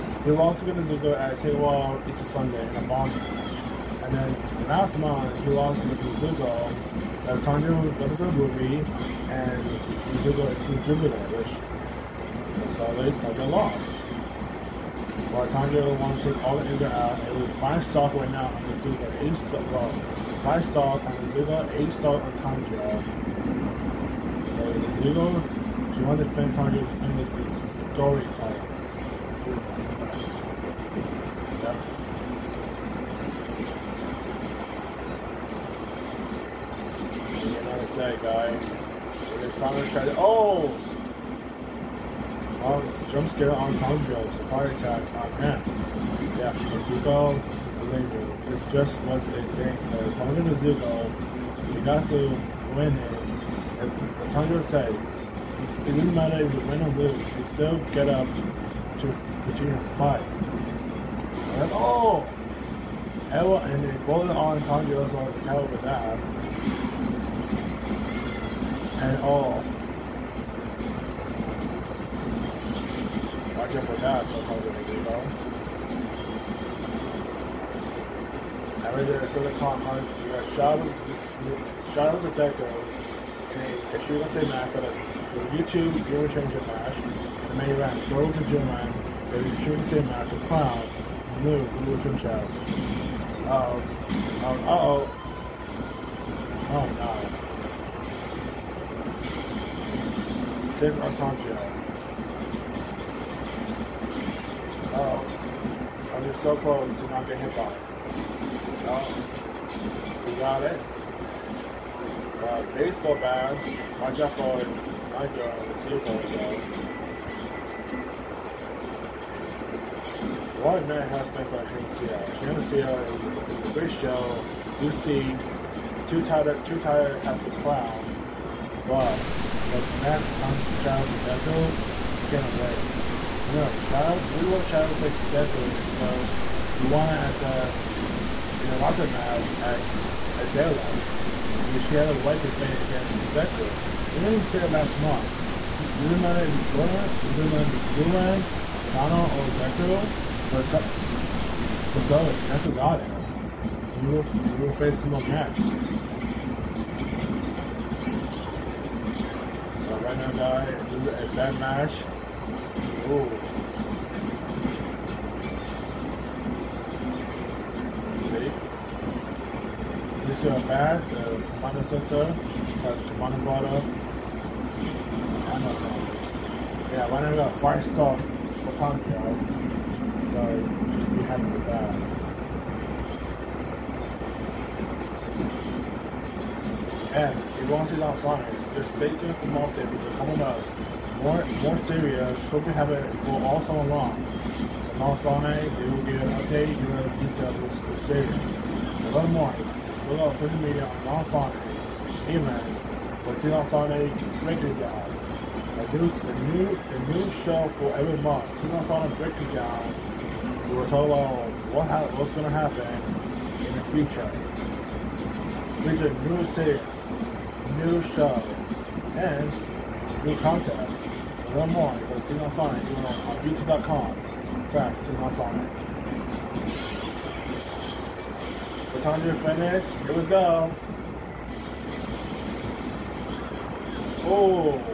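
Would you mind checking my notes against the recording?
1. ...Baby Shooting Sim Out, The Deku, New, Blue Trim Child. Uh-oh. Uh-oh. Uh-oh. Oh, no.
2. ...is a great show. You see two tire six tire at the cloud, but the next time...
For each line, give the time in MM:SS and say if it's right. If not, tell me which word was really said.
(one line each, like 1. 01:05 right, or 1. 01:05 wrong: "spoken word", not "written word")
1. 01:29 wrong: "Clown", not "Deku"
2. 02:03 wrong: "two", not "six".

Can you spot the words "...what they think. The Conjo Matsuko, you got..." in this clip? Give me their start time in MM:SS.
00:49.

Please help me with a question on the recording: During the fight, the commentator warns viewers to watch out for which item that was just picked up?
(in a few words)
Baseball bat.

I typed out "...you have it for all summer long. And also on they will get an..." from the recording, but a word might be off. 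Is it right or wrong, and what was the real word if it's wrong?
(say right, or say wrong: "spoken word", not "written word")
right.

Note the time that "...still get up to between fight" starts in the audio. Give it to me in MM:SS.
00:57.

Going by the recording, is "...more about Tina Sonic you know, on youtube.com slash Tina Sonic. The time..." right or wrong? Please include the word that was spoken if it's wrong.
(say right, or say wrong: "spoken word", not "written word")
right.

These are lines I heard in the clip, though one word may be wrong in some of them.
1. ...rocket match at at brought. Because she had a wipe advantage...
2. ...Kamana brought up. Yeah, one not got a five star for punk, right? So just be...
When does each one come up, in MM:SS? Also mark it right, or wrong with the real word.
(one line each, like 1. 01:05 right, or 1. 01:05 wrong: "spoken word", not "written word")
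1. 02:18 wrong: "daylight", not "brought"
2. 02:53 right.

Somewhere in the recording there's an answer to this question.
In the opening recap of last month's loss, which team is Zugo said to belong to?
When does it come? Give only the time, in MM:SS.
00:10.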